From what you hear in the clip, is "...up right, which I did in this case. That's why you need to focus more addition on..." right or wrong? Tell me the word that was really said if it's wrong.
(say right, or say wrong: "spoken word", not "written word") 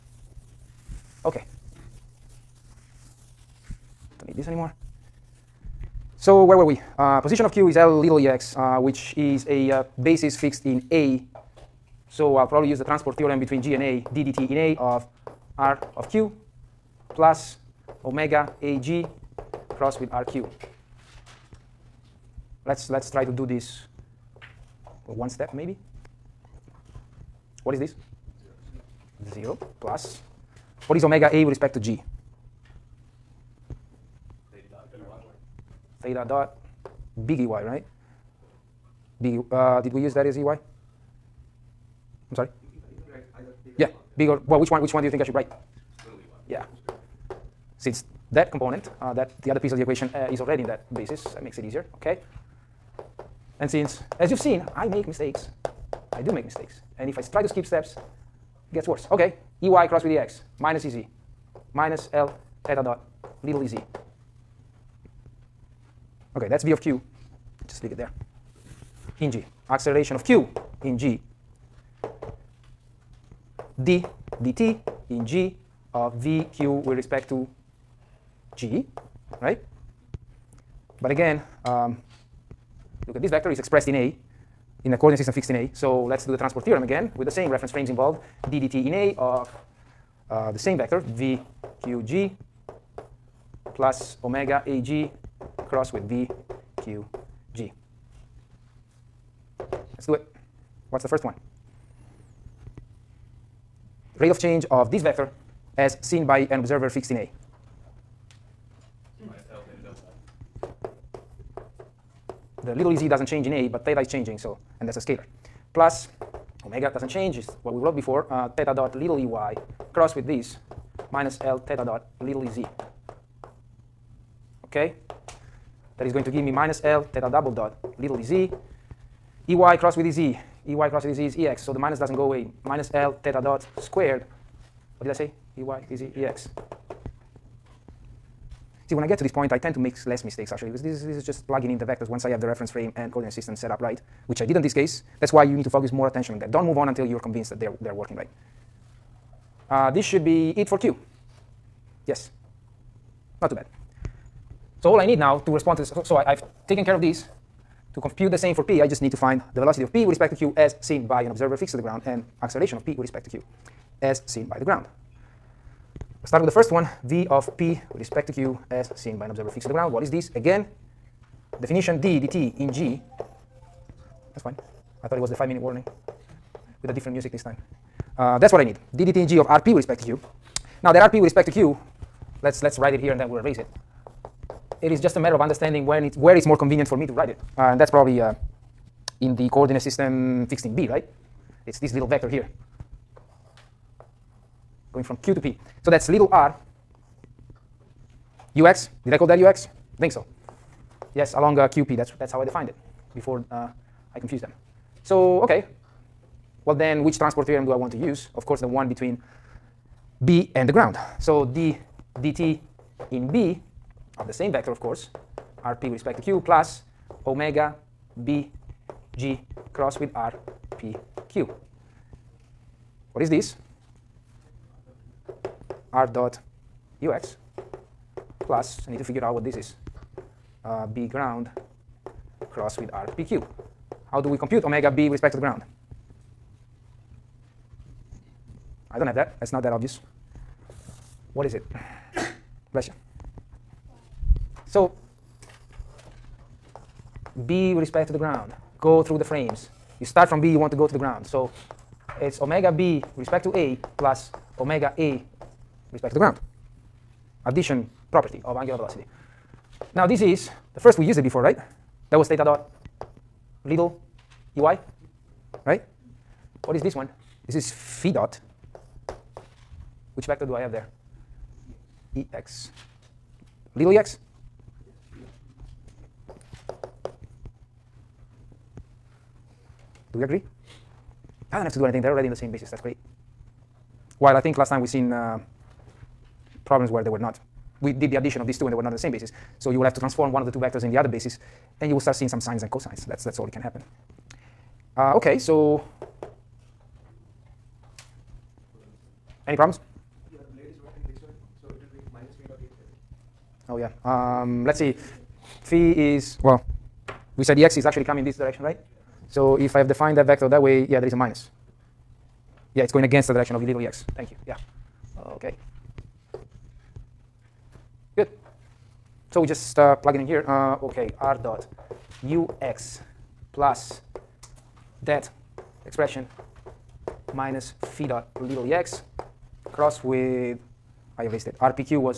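wrong: "attention", not "addition".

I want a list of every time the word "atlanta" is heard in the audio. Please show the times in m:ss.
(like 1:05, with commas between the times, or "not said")
not said.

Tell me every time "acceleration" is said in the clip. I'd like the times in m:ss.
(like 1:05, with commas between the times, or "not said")
1:09, 2:42.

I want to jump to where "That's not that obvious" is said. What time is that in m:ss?
3:59.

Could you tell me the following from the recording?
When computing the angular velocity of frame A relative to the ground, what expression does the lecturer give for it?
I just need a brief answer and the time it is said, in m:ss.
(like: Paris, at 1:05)
theta dot big EY, at 0:36.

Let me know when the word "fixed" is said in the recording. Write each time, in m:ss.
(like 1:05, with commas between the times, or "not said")
0:10, 1:25, 1:46, 2:41, 2:49, 3:10.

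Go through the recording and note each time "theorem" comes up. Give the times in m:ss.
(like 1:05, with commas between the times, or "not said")
0:13, 1:26, 3:27.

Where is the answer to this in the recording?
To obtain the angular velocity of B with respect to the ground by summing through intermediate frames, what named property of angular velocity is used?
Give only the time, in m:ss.
4:17.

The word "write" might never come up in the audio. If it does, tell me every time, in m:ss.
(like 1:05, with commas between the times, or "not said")
0:45, 3:02, 3:07.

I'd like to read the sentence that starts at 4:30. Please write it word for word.
Which vector do I have there?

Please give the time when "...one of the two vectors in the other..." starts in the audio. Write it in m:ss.
4:50.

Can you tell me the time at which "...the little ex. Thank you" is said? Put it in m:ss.
5:13.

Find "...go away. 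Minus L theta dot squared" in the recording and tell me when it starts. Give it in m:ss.
2:12.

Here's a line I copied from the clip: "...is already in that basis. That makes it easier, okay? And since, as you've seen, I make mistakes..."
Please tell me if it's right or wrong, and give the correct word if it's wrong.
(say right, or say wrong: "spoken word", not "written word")
right.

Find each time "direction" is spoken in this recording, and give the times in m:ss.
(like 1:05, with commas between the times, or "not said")
5:08, 5:13.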